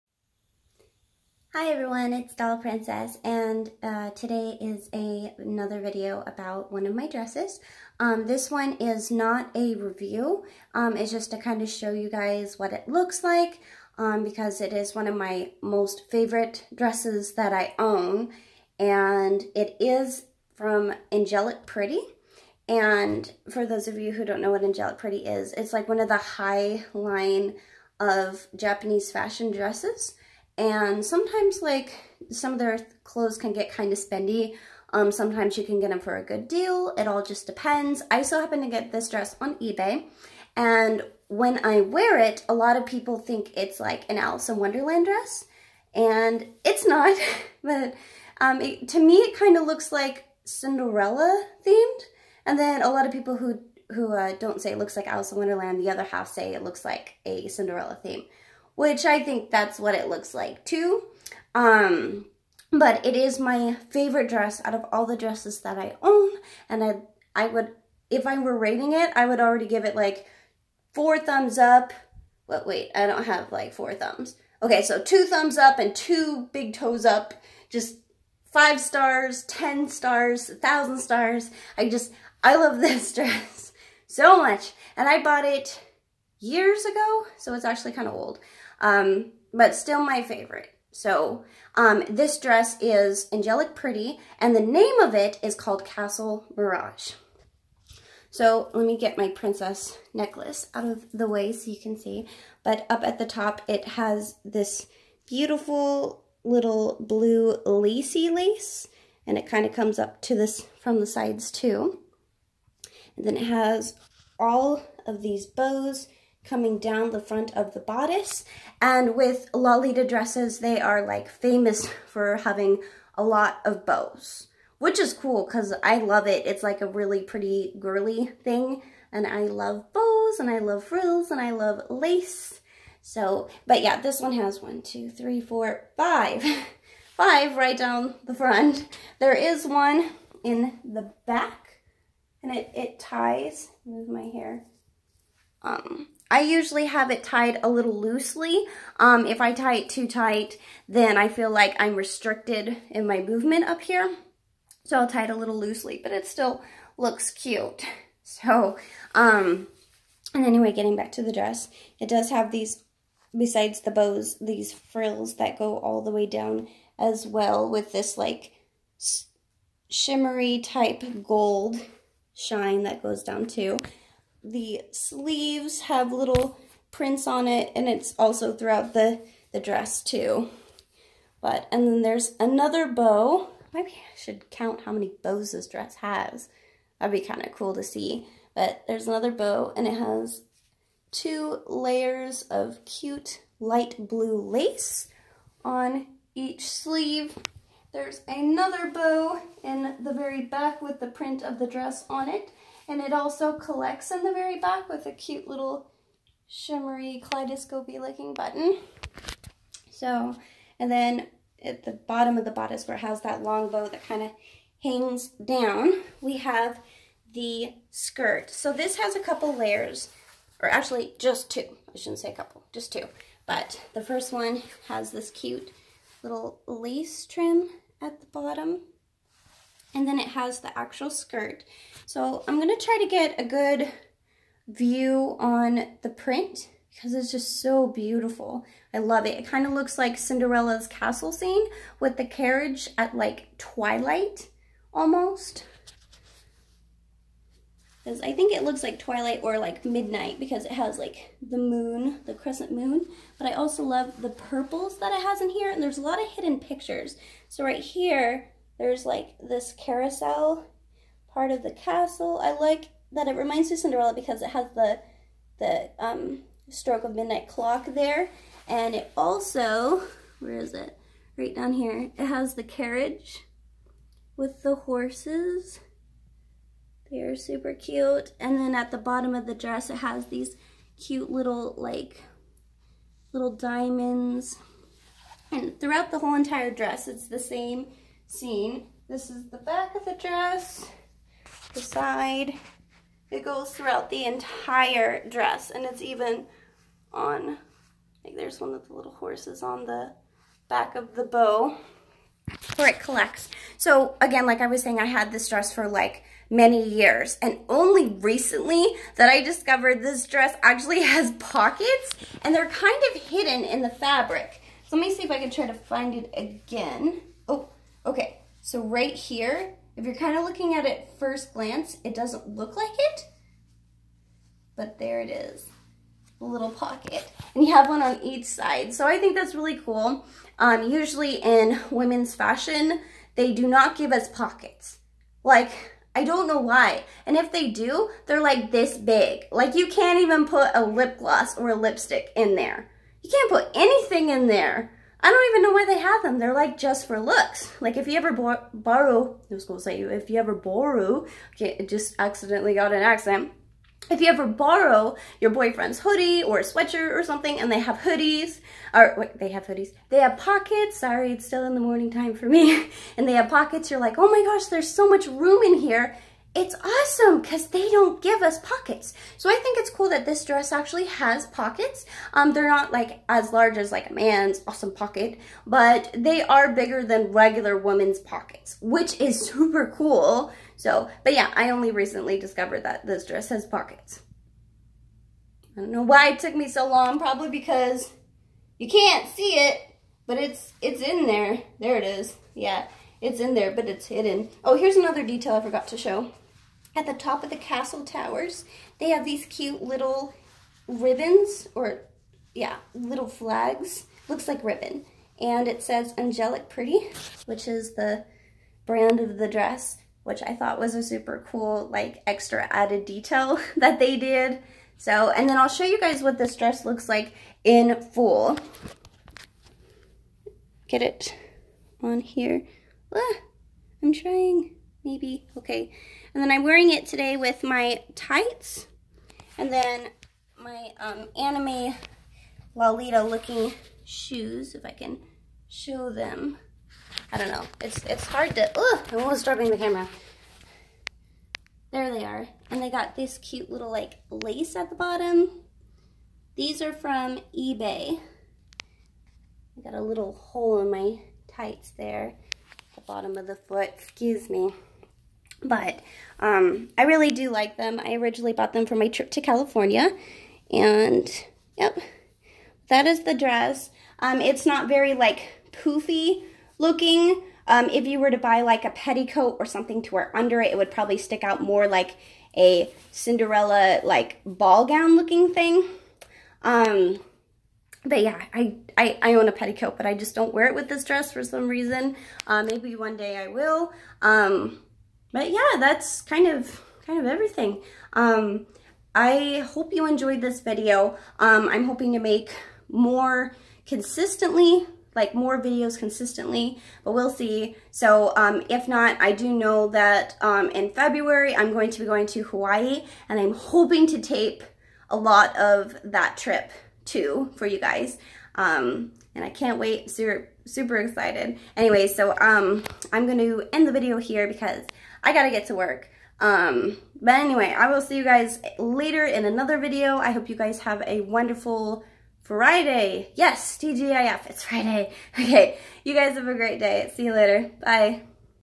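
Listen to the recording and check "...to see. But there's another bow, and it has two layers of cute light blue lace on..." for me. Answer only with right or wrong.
right.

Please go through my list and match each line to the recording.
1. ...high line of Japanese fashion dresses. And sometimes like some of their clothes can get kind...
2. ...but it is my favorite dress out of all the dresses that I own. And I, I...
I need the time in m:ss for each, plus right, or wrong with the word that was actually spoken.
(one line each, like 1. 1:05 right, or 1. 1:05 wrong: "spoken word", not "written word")
1. 0:26 right
2. 1:02 right.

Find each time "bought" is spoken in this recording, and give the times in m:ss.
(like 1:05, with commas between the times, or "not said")
1:25, 7:38.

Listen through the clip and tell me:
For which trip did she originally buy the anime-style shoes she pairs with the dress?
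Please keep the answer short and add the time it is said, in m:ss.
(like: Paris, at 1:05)
California, at 7:39.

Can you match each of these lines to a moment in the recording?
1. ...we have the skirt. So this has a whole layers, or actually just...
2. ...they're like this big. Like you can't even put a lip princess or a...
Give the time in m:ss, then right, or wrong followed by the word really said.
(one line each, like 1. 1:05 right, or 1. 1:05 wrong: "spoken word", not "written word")
1. 3:36 wrong: "couple", not "whole"
2. 5:38 wrong: "gloss", not "princess".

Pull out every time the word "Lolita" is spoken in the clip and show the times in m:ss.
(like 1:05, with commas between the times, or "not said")
1:59, 7:12.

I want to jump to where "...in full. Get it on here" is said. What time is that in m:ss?
6:57.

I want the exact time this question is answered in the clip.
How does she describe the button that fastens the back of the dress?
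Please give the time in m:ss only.
3:26.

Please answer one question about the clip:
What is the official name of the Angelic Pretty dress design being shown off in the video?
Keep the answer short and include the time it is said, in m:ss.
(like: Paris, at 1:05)
Castle Mirage, at 1:35.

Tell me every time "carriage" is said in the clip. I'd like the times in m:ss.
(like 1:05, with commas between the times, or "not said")
4:02, 4:32.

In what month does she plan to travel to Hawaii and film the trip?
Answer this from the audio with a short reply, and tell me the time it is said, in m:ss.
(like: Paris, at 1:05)
February, at 8:20.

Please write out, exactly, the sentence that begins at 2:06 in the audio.
It's like a really pretty girly thing.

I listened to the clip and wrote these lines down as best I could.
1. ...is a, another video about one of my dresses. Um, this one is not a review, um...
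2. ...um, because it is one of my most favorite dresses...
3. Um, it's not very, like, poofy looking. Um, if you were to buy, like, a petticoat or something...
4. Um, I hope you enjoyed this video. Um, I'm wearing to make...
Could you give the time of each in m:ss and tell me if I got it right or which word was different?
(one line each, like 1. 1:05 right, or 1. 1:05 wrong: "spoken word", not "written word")
1. 0:04 right
2. 0:13 right
3. 7:44 right
4. 8:08 wrong: "hoping", not "wearing".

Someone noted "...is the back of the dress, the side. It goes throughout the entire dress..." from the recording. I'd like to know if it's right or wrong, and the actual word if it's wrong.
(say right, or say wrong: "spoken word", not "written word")
right.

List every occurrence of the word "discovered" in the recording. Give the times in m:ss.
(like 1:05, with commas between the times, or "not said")
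5:09, 6:22.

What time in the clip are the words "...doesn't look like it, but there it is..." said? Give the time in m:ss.
5:22.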